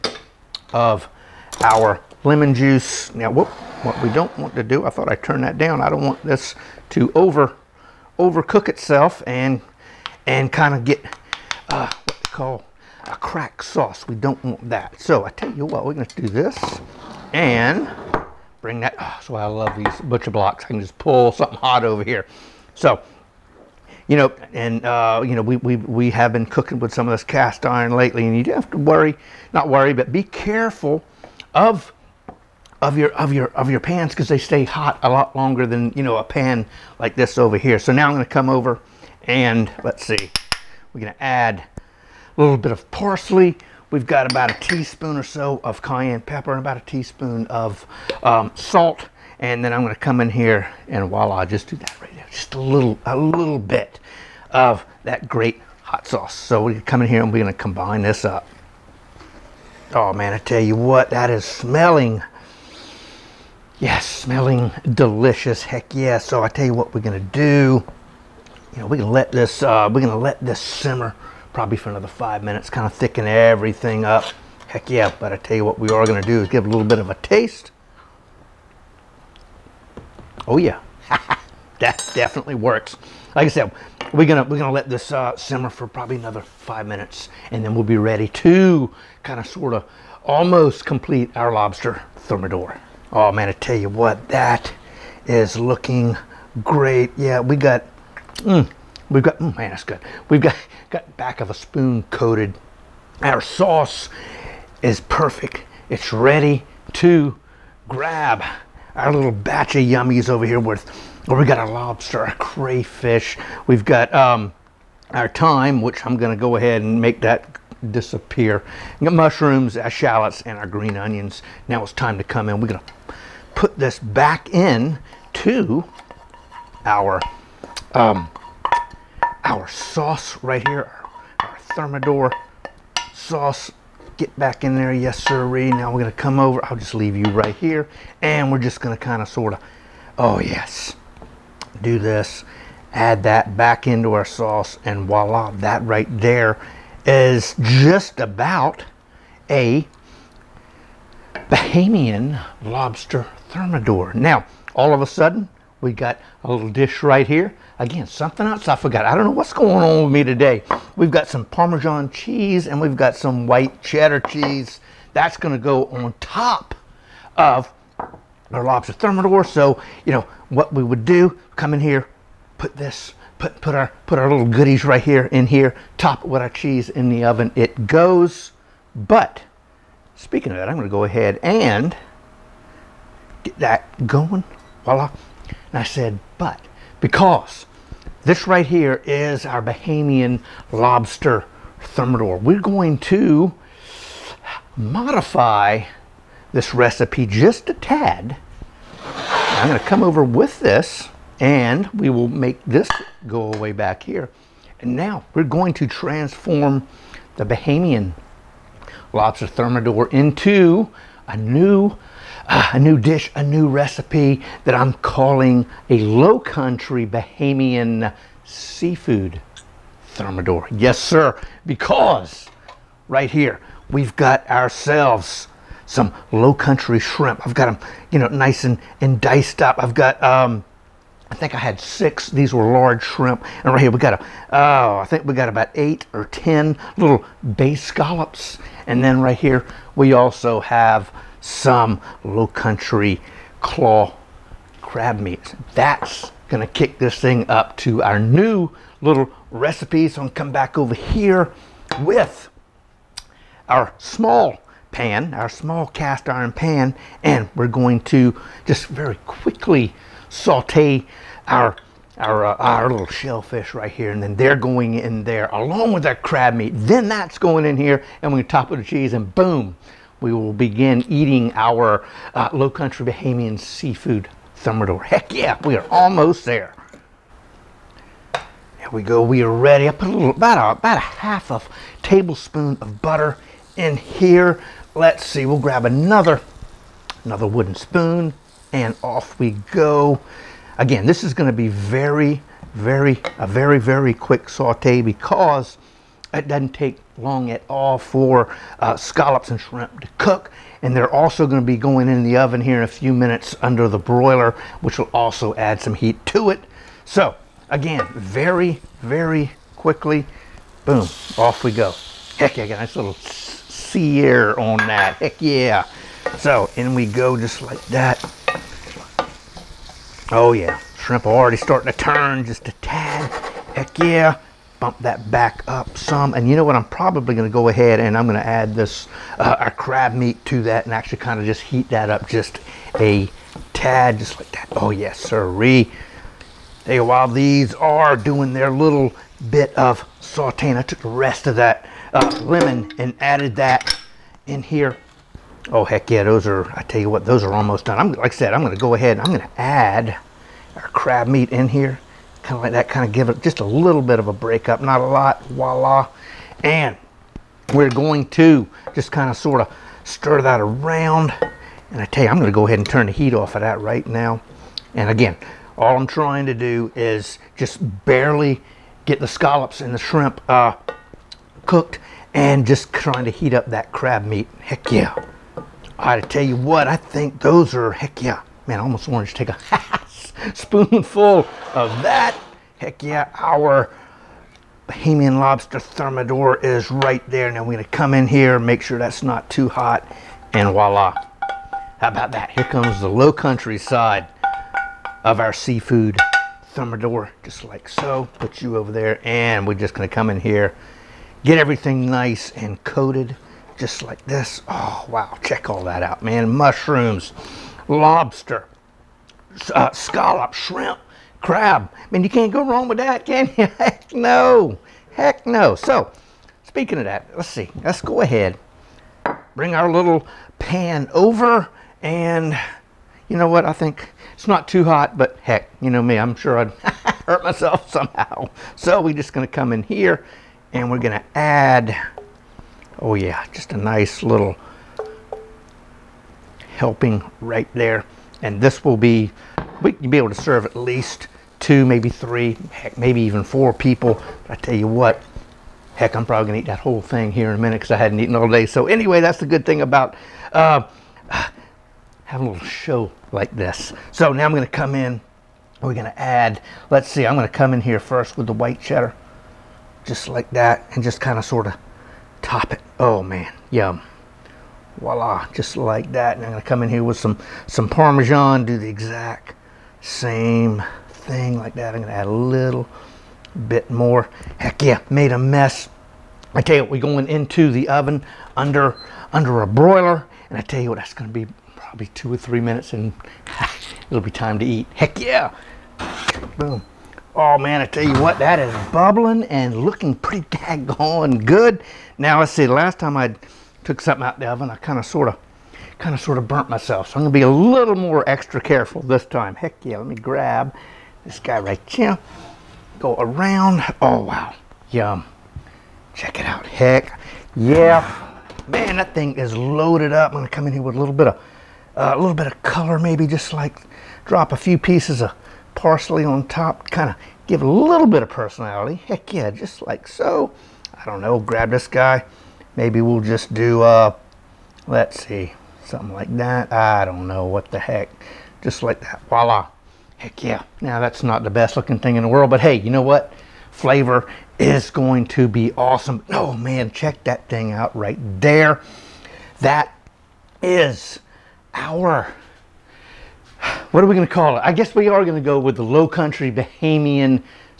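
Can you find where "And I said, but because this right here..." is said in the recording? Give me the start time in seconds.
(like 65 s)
185 s.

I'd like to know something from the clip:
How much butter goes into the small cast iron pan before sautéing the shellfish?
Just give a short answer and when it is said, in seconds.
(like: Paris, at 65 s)
half a tablespoon, at 280 s.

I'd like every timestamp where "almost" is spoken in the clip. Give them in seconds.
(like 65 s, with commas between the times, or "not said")
90 s, 275 s, 347 s, 378 s.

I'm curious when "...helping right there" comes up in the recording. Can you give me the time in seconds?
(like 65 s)
436 s.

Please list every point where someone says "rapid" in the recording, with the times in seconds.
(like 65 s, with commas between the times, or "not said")
not said.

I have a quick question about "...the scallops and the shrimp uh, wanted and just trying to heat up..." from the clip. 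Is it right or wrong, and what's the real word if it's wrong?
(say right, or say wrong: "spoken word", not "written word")
wrong: "cooked", not "wanted".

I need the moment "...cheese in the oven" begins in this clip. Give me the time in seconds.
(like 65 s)
176 s.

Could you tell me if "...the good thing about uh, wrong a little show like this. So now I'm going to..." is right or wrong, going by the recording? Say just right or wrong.
wrong.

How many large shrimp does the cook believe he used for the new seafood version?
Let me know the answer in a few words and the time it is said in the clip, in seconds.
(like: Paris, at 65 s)
6, at 231 s.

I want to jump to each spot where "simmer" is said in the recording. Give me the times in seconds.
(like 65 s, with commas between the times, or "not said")
70 s, 85 s.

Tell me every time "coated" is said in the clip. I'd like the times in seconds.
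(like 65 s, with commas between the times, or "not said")
102 s, 402 s.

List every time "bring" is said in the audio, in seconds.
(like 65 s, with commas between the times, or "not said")
18 s, 419 s.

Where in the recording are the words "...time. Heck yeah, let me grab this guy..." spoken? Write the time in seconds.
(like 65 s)
499 s.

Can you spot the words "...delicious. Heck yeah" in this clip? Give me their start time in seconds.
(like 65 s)
64 s.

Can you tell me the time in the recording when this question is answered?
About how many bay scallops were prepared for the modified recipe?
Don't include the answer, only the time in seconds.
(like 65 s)
235 s.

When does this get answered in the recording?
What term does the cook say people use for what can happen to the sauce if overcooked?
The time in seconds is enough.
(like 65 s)
13 s.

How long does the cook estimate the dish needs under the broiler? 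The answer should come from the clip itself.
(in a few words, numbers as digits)
2 or 3 minutes.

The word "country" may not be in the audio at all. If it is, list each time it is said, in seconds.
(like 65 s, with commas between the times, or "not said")
216 s, 226 s, 242 s, 272 s, 393 s, 546 s.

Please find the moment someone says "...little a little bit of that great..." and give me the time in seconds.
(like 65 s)
52 s.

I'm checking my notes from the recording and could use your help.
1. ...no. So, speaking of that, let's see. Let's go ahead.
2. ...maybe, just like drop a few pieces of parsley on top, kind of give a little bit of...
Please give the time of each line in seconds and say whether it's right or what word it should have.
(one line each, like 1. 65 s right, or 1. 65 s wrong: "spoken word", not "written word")
1. 415 s right
2. 512 s right.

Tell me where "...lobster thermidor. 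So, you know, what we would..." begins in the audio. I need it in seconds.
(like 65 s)
168 s.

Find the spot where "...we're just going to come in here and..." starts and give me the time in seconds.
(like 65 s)
429 s.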